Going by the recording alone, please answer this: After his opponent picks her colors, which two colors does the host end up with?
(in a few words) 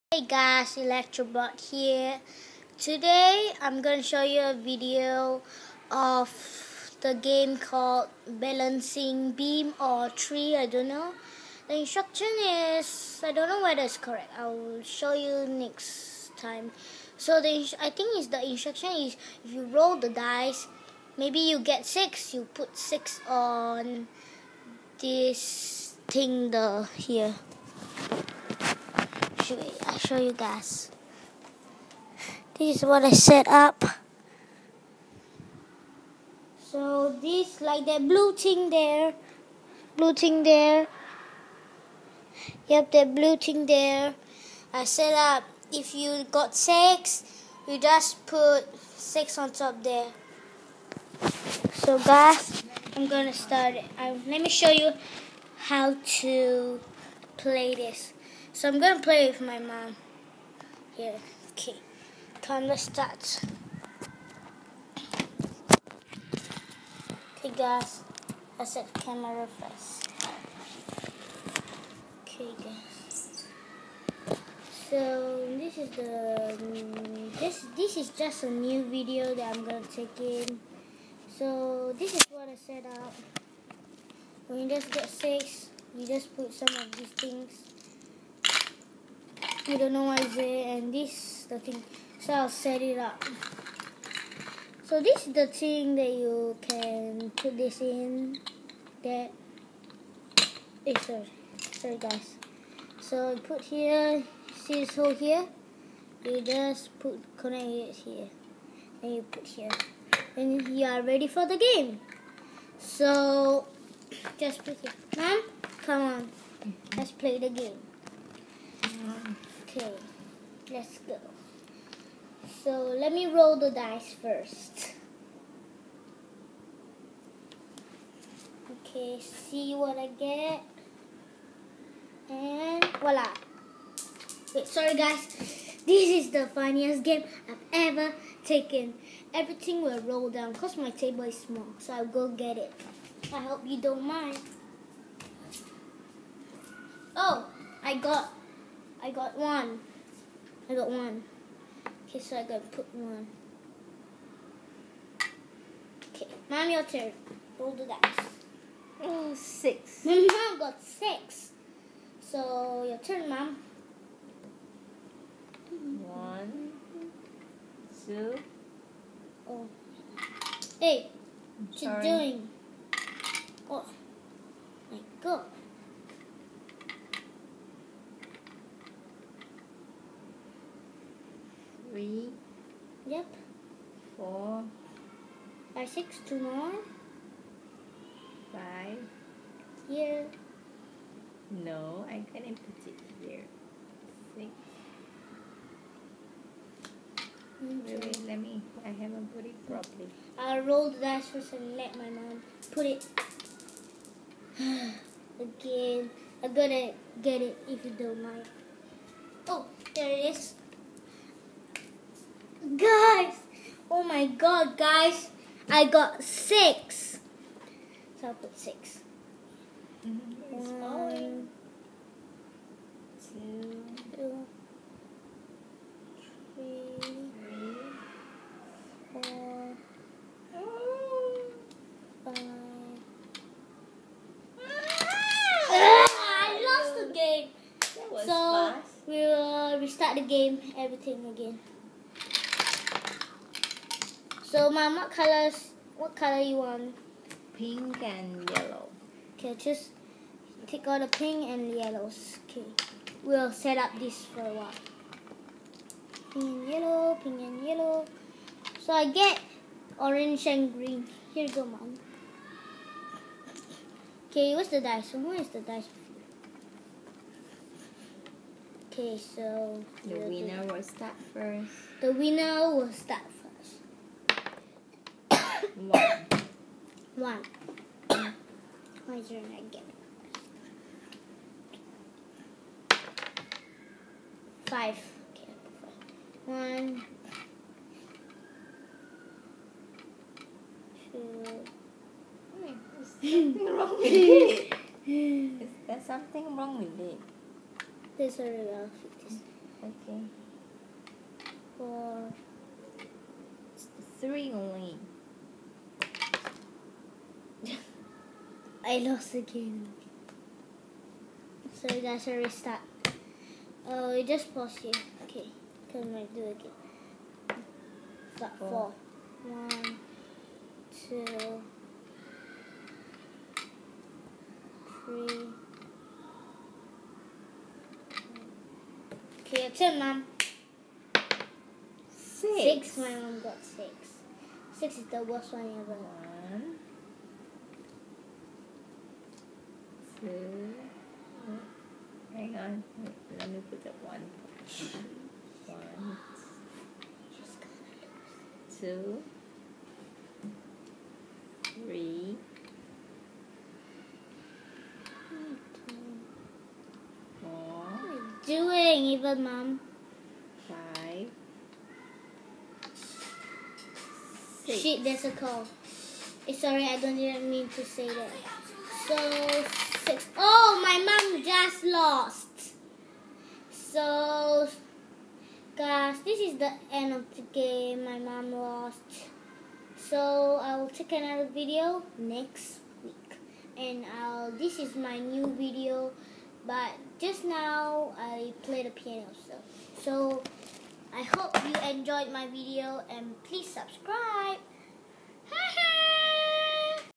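orange and green.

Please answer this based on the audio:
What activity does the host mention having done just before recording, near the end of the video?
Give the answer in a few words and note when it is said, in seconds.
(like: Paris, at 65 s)
played the piano, at 388 s.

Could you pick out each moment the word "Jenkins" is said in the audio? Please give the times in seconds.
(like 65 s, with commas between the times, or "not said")
not said.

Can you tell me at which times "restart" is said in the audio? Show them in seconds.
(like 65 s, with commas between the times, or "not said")
239 s, 312 s.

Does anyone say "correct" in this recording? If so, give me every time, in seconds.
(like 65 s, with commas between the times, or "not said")
13 s.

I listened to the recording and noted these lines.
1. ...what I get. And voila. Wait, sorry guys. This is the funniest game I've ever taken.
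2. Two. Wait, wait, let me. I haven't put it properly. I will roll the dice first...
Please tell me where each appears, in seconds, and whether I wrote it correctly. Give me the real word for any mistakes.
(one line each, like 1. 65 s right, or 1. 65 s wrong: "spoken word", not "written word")
1. 129 s right
2. 194 s wrong: "Six", not "Two".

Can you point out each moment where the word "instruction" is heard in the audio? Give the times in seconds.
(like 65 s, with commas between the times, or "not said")
11 s, 18 s.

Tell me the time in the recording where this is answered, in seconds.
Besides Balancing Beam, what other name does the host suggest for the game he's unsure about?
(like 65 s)
10 s.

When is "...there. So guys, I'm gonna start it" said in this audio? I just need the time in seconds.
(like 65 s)
49 s.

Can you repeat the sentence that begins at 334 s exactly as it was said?
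Six is the worst one ever.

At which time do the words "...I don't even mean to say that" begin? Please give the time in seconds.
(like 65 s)
366 s.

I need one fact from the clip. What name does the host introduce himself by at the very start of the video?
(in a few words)
Electrobot.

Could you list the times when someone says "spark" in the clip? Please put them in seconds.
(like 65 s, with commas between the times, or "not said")
not said.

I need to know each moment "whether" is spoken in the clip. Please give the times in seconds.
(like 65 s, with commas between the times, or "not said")
13 s.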